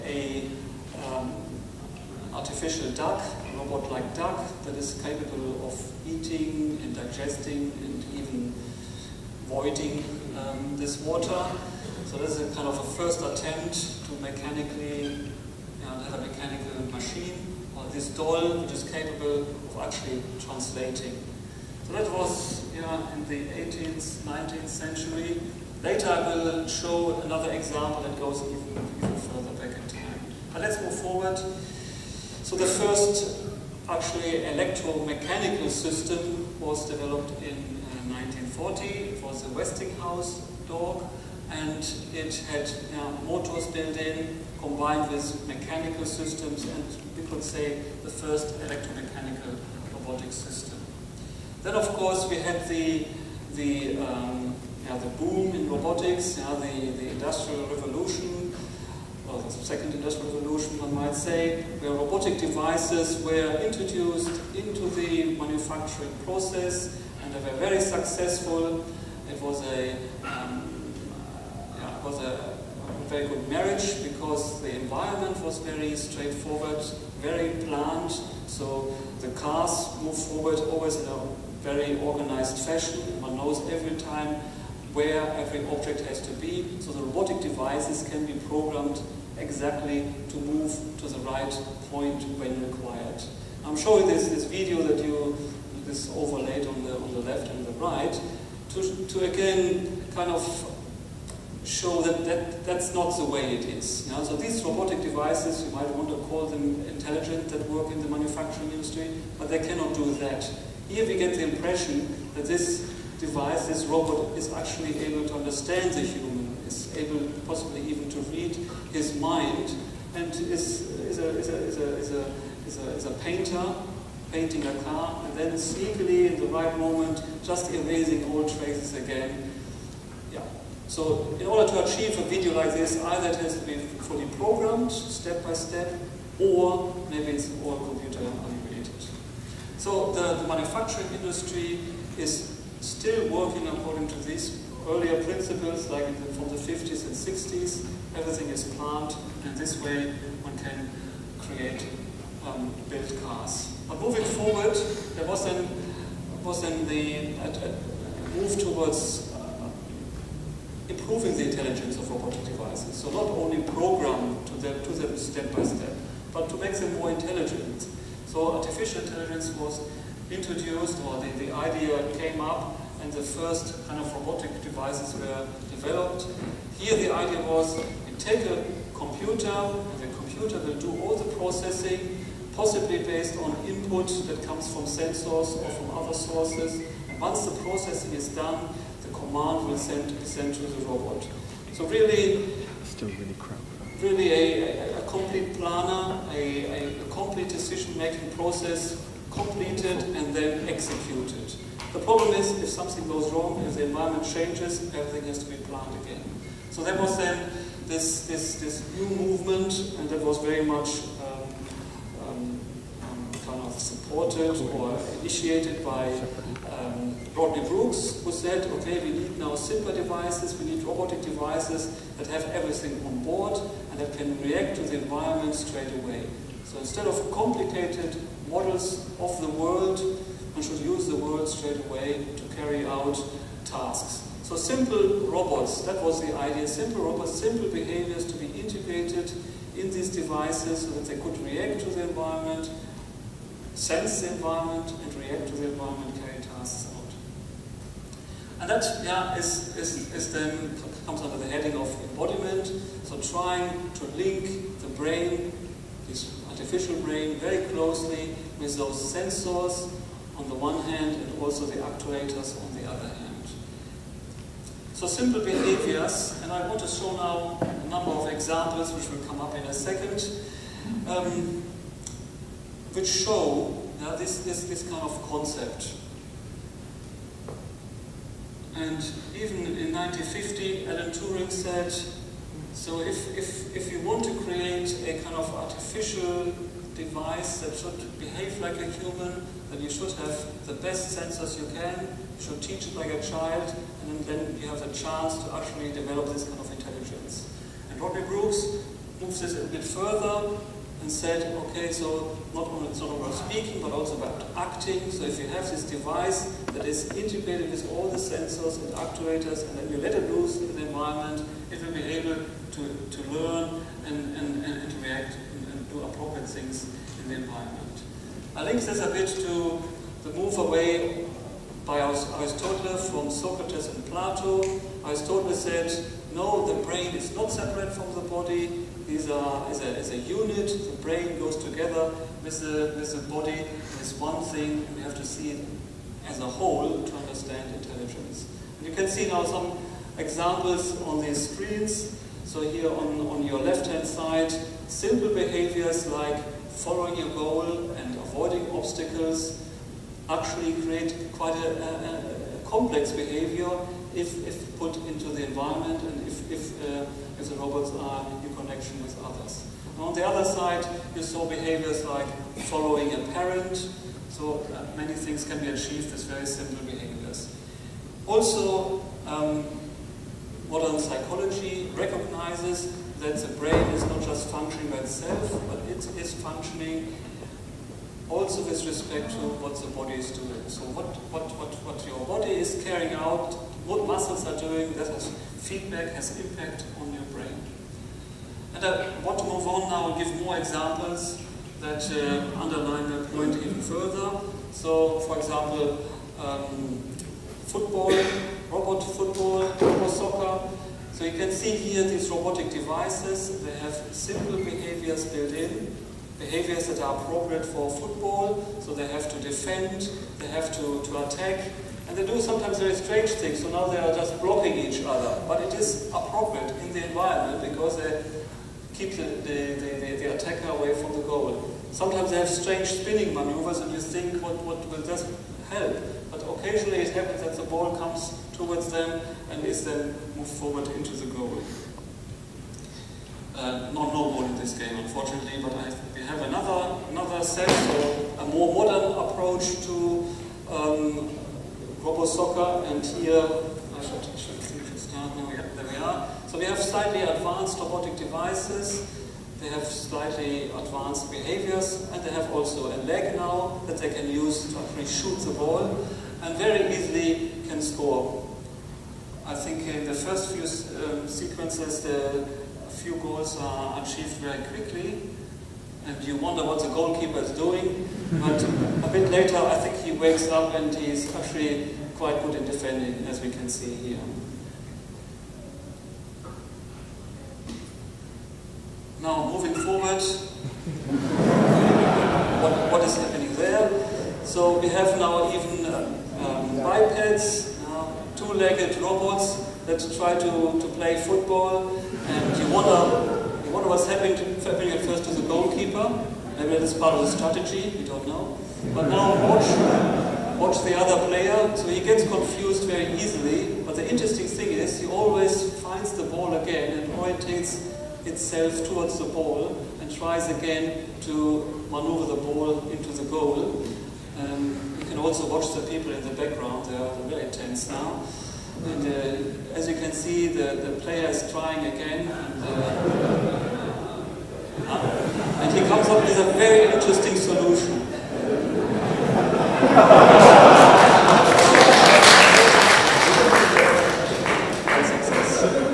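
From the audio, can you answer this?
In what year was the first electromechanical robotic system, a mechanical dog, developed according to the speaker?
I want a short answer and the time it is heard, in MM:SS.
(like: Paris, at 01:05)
1940, at 00:38.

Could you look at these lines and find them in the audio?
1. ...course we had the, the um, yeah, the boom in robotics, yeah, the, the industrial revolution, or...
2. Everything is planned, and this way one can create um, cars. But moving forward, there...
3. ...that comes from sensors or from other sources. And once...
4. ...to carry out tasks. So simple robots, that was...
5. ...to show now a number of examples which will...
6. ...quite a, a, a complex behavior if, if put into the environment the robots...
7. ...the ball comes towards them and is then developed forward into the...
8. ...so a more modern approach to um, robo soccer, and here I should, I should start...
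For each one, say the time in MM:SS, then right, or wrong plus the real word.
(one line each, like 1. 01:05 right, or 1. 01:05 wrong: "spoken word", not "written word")
1. 00:51 right
2. 02:28 right
3. 03:04 right
4. 03:52 right
5. 04:26 right
6. 05:51 right
7. 07:07 wrong: "moved", not "developed"
8. 07:17 right.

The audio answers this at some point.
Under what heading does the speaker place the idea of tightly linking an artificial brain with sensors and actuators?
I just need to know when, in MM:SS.
04:12.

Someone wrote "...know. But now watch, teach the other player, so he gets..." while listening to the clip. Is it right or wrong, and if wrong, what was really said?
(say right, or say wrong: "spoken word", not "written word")
wrong: "watch", not "teach".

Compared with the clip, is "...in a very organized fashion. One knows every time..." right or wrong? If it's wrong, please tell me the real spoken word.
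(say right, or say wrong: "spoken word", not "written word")
right.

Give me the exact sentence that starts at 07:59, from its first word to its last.
Now moving forward, what, what is happening there?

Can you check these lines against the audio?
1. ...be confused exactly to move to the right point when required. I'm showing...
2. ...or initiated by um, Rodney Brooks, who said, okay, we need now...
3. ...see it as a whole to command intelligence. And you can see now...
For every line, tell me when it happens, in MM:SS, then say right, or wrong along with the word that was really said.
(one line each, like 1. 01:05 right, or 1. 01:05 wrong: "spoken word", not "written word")
1. 01:28 wrong: "programmed", not "confused"
2. 03:34 right
3. 05:35 wrong: "understand", not "command".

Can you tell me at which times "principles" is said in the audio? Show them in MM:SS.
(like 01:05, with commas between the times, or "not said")
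02:25.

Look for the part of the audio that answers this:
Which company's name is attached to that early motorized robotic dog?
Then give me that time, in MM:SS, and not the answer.
00:39.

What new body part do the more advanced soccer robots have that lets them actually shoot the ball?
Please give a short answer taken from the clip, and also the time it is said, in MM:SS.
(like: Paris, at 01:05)
a leg, at 07:32.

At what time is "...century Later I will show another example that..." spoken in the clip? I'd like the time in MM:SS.
00:24.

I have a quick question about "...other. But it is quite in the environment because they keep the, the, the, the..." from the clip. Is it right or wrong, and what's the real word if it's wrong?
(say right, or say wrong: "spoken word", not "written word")
wrong: "appropriate", not "quite".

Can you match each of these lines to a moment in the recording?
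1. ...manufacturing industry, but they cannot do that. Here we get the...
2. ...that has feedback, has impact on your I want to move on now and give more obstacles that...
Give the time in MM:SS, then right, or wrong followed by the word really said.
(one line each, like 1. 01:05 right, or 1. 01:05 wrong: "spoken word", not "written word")
1. 01:48 right
2. 06:24 wrong: "examples", not "obstacles".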